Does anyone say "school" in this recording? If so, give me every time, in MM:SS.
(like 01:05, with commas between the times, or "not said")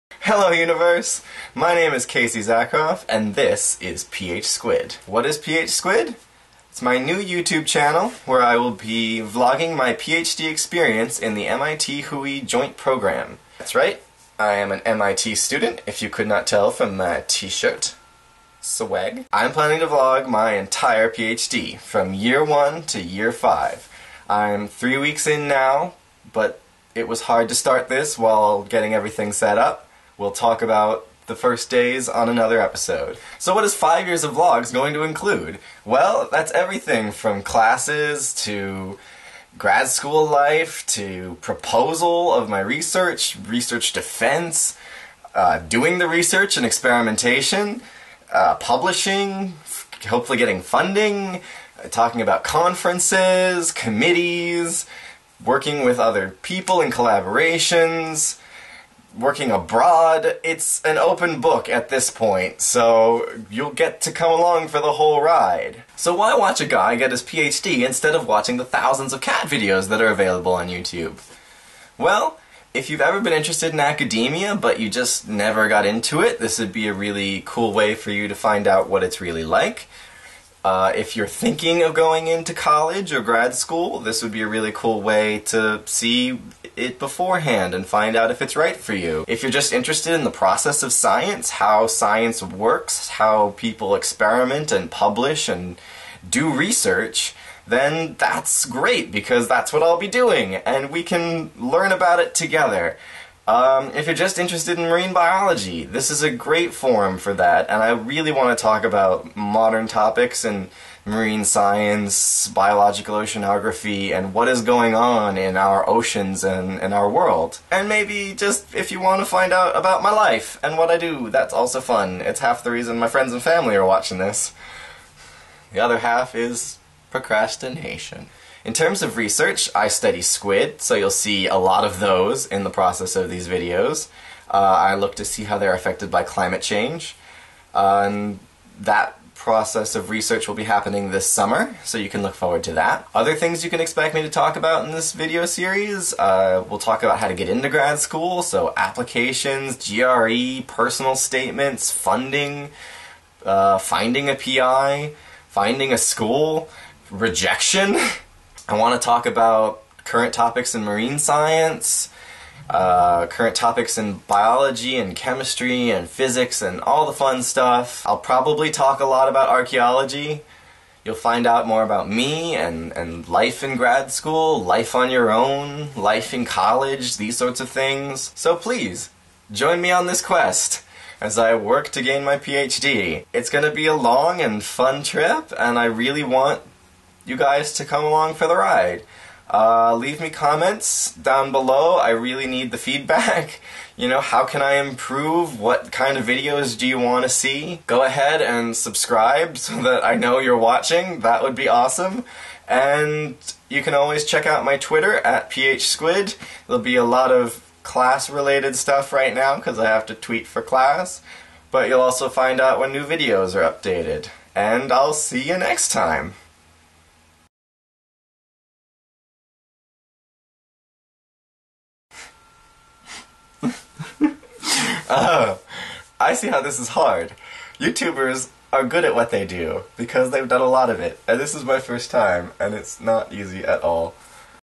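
00:39, 01:23, 02:27, 02:35, 02:54.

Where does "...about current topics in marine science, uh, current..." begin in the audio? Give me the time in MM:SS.
02:39.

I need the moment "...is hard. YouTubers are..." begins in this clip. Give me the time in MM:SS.
03:46.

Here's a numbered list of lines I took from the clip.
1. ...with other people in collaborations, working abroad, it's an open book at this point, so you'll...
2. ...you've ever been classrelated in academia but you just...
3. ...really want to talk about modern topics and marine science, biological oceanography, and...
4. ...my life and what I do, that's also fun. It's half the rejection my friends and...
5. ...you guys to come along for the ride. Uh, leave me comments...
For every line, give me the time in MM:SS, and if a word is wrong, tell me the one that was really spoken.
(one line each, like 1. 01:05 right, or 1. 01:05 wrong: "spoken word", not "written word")
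1. 00:55 right
2. 01:12 wrong: "interested", not "classrelated"
3. 01:47 right
4. 02:00 wrong: "reason", not "rejection"
5. 03:07 right.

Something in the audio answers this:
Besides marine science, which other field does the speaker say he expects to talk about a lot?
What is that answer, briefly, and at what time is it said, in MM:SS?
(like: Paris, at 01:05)
archaeology, at 02:49.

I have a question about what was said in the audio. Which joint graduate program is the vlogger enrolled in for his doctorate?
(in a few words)
MIT WHOI Joint Program.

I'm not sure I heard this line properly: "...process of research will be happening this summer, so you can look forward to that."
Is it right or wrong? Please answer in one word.
right.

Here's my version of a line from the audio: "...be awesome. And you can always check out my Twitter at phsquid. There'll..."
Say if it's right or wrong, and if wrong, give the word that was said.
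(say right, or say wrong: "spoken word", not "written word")
right.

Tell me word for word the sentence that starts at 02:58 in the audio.
So please, join me on this quest as I work to gain my PhD.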